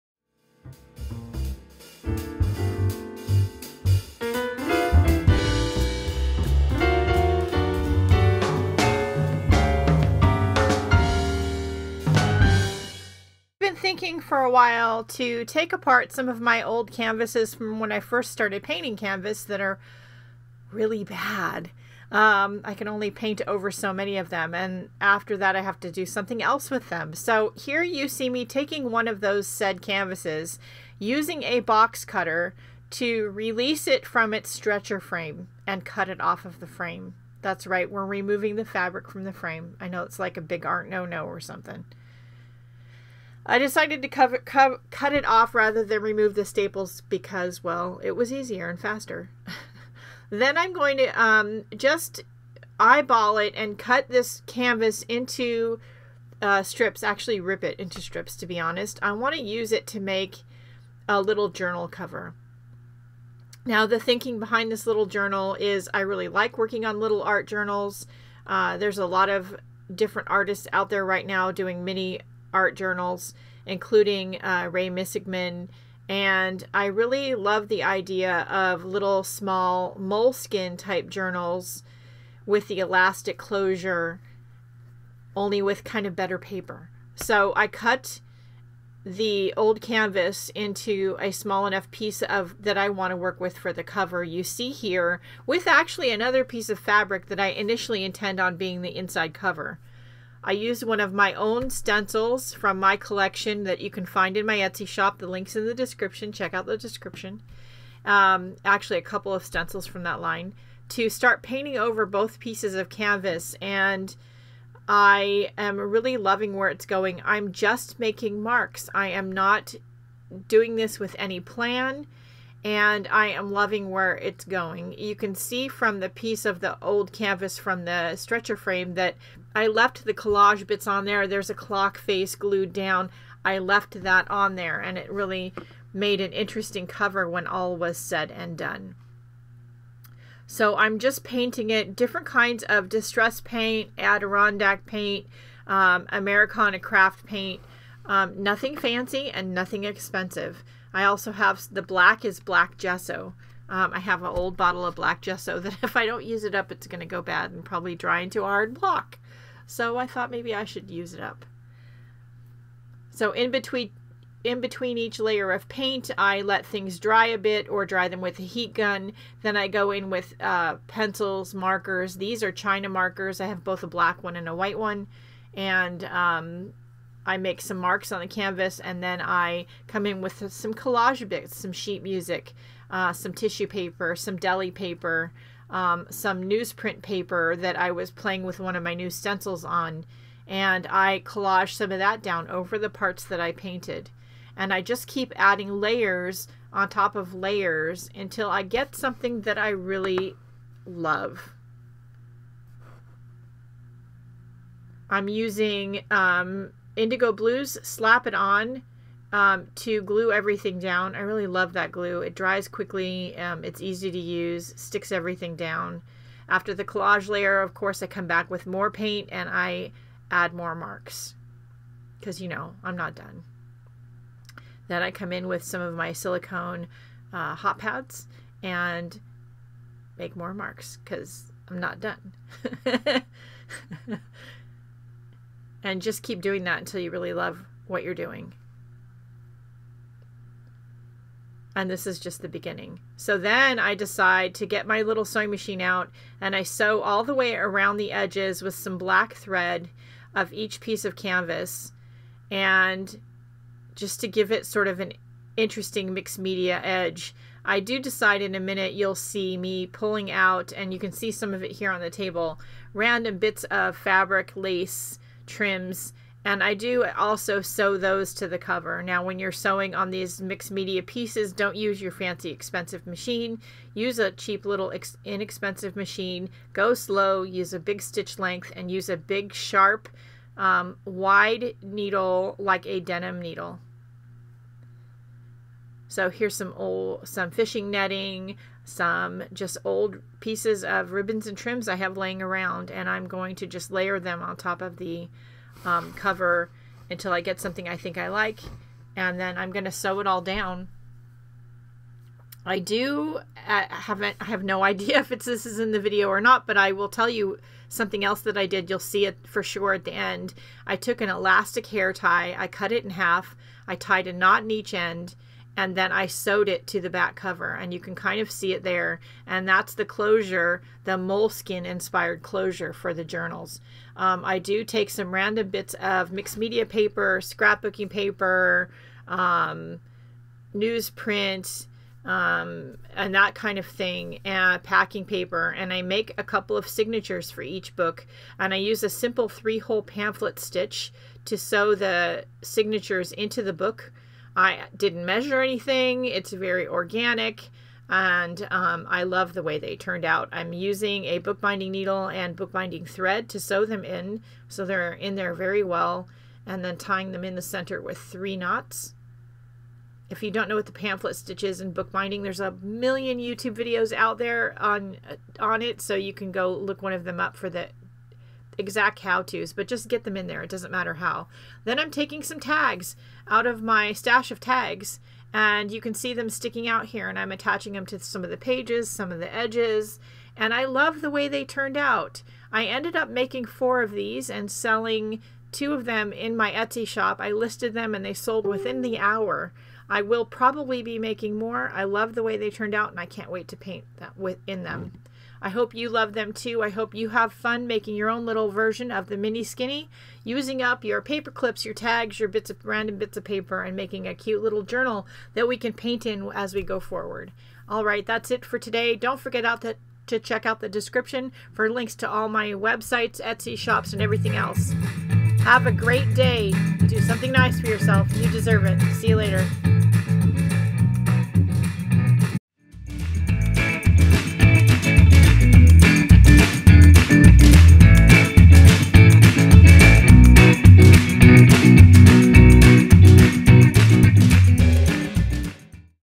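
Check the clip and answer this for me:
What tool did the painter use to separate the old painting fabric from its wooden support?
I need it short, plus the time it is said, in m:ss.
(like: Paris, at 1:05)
box cutter, at 0:31.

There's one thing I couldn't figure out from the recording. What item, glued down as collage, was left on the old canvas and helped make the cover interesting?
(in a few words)
clock face.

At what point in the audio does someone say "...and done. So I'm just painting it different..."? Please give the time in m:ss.
2:18.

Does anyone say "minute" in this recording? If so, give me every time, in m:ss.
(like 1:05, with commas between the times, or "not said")
4:18.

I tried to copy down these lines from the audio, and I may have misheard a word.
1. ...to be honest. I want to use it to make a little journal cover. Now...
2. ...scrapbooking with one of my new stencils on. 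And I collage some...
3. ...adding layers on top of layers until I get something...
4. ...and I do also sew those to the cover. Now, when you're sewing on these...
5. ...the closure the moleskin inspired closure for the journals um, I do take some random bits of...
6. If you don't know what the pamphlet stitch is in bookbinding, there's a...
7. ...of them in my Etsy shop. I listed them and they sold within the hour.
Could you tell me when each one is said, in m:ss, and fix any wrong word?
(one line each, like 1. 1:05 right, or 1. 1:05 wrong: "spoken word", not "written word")
1. 0:58 right
2. 3:08 wrong: "playing", not "scrapbooking"
3. 3:15 right
4. 4:26 right
5. 5:19 right
6. 6:00 right
7. 6:25 right.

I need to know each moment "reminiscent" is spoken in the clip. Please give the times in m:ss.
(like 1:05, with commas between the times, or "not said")
not said.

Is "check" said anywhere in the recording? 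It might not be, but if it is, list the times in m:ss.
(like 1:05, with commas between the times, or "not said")
1:46, 6:50.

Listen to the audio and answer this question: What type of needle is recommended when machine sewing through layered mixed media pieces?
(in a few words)
denim needle.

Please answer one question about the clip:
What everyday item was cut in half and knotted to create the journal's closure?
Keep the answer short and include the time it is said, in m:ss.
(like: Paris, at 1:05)
elastic hair tie, at 5:11.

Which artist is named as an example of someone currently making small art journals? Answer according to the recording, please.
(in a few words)
Rae Missigman.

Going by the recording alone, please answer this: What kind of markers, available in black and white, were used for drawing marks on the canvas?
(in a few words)
China markers.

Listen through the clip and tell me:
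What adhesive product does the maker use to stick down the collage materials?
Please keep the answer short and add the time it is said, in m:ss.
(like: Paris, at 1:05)
slap it on, at 3:27.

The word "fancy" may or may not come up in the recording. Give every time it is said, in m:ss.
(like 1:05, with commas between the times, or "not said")
2:28, 4:32.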